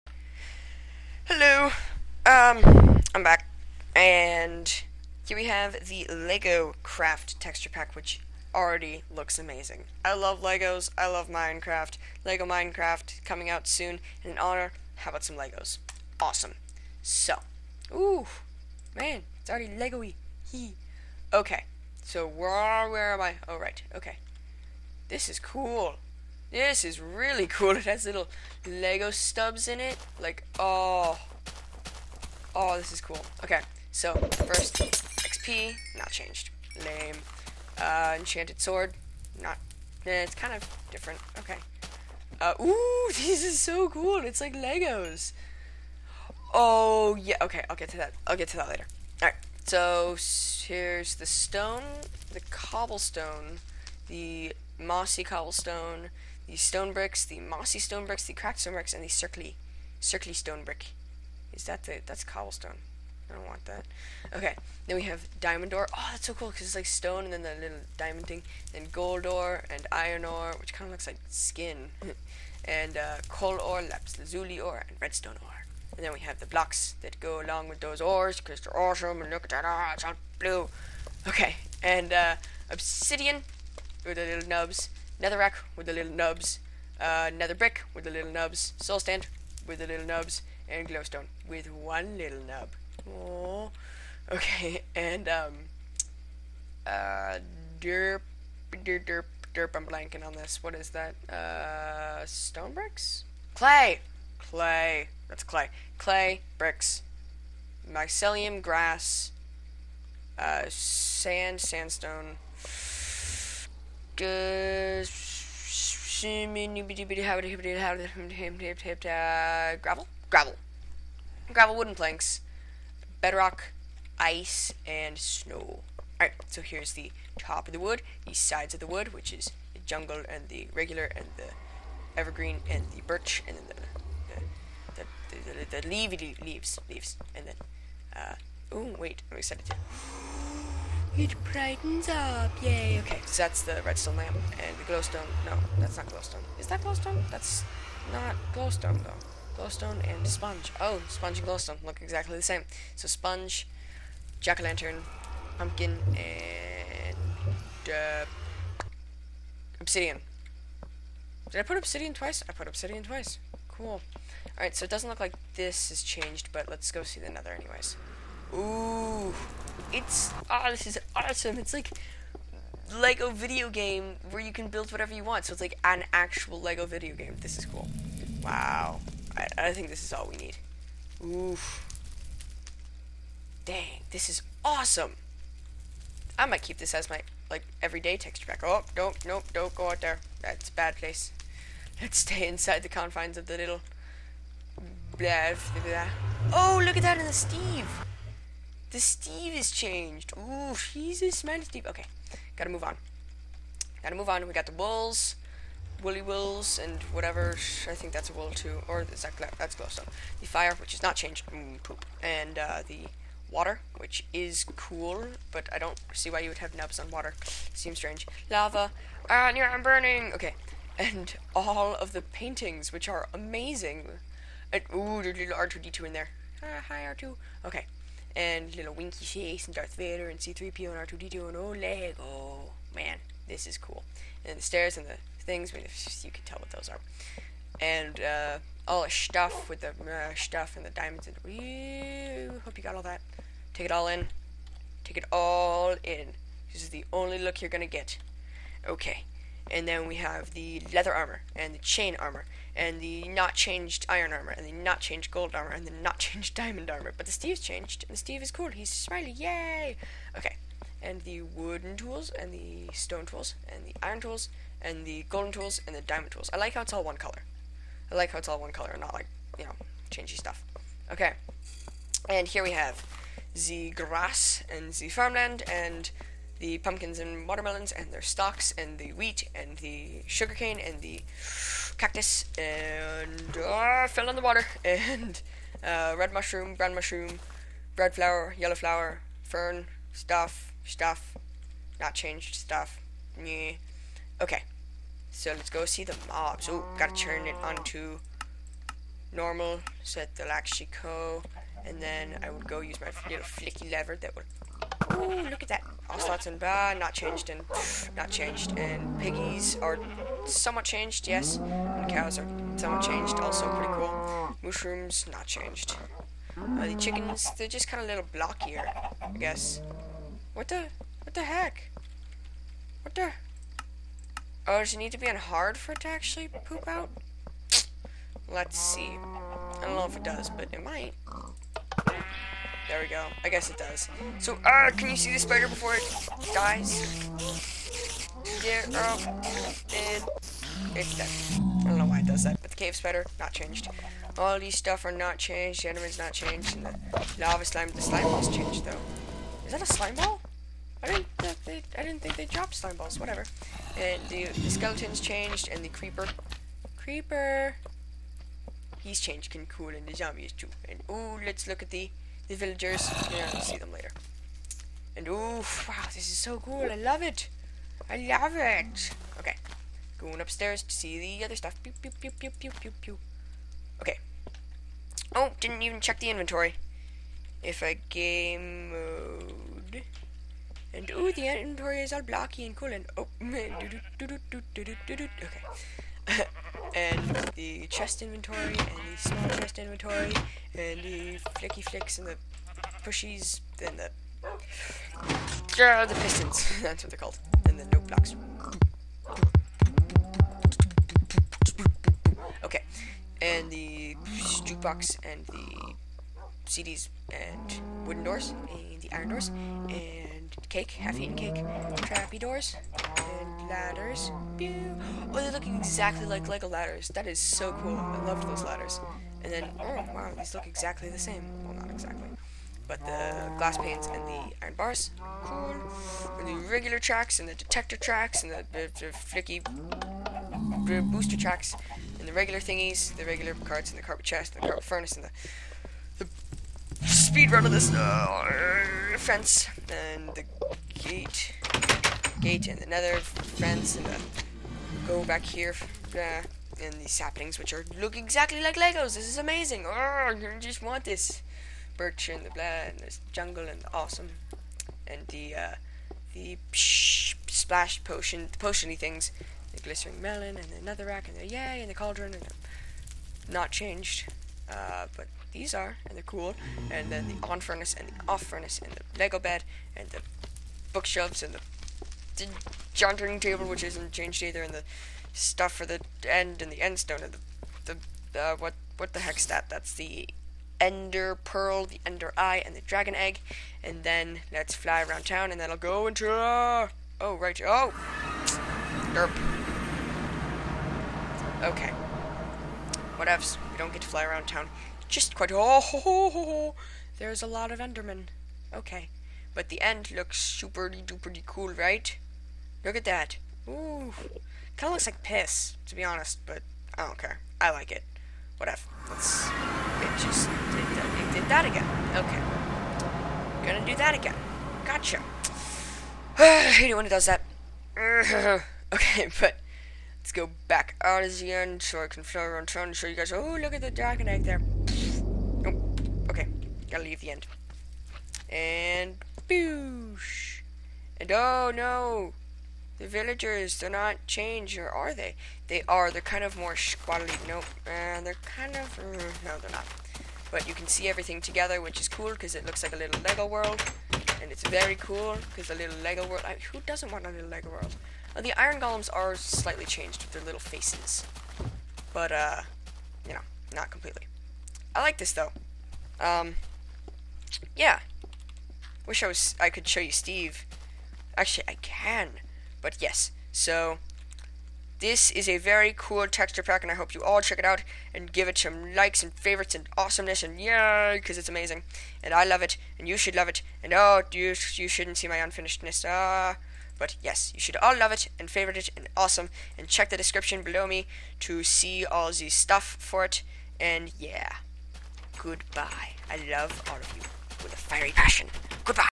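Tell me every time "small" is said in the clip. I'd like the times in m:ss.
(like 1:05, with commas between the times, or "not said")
6:29.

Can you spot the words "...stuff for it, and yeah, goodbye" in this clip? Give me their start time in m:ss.
9:42.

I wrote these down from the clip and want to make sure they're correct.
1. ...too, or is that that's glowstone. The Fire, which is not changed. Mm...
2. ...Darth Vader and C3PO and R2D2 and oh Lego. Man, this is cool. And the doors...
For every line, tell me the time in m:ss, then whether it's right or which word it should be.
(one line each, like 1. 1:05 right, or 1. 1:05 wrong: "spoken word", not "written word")
1. 3:28 right
2. 3:49 wrong: "stairs", not "doors".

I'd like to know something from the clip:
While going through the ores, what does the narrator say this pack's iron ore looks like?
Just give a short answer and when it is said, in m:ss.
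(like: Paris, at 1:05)
skin, at 1:10.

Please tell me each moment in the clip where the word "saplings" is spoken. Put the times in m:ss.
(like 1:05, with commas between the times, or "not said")
7:27.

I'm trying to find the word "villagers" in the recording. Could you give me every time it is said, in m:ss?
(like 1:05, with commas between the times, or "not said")
6:02, 8:53.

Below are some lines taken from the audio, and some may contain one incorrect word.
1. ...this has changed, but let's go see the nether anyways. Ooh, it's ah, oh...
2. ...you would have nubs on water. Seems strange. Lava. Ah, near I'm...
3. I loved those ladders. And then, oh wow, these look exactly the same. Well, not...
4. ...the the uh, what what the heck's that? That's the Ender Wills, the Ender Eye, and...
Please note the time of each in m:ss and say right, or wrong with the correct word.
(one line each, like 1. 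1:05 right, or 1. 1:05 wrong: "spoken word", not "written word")
1. 2:45 right
2. 3:36 right
3. 6:57 right
4. 7:57 wrong: "Pearl", not "Wills".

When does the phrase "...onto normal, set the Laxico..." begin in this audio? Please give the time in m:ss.
4:57.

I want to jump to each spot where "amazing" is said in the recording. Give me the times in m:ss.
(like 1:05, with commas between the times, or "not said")
0:09, 3:43, 7:29, 9:31.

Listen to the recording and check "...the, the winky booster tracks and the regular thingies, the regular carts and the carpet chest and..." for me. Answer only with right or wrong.
wrong.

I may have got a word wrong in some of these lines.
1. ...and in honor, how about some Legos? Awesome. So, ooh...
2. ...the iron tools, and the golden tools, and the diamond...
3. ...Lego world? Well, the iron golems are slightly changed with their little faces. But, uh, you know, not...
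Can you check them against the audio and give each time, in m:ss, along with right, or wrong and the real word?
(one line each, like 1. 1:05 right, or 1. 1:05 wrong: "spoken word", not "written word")
1. 0:14 right
2. 4:23 right
3. 9:07 right.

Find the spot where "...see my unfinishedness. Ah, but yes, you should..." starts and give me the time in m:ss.
9:35.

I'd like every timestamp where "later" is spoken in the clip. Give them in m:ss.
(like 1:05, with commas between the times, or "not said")
0:48, 6:03.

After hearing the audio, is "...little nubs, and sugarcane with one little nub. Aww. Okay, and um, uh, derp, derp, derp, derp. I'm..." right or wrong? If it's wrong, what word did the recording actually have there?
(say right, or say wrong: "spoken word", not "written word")
wrong: "glowstone", not "sugarcane".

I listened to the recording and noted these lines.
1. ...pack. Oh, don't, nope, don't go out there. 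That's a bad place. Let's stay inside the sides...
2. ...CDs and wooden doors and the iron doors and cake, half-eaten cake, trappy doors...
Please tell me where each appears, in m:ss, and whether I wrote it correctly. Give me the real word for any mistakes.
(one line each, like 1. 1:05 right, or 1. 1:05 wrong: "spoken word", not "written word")
1. 3:08 wrong: "confines", not "sides"
2. 6:46 right.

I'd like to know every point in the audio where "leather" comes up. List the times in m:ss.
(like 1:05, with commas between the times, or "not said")
4:10.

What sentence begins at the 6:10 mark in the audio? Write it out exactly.
Going upstairs to see the other stuff.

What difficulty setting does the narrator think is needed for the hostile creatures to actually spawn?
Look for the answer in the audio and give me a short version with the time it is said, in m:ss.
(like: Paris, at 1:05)
hard, at 5:24.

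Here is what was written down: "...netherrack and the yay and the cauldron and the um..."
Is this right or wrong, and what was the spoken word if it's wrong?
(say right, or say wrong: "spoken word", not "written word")
right.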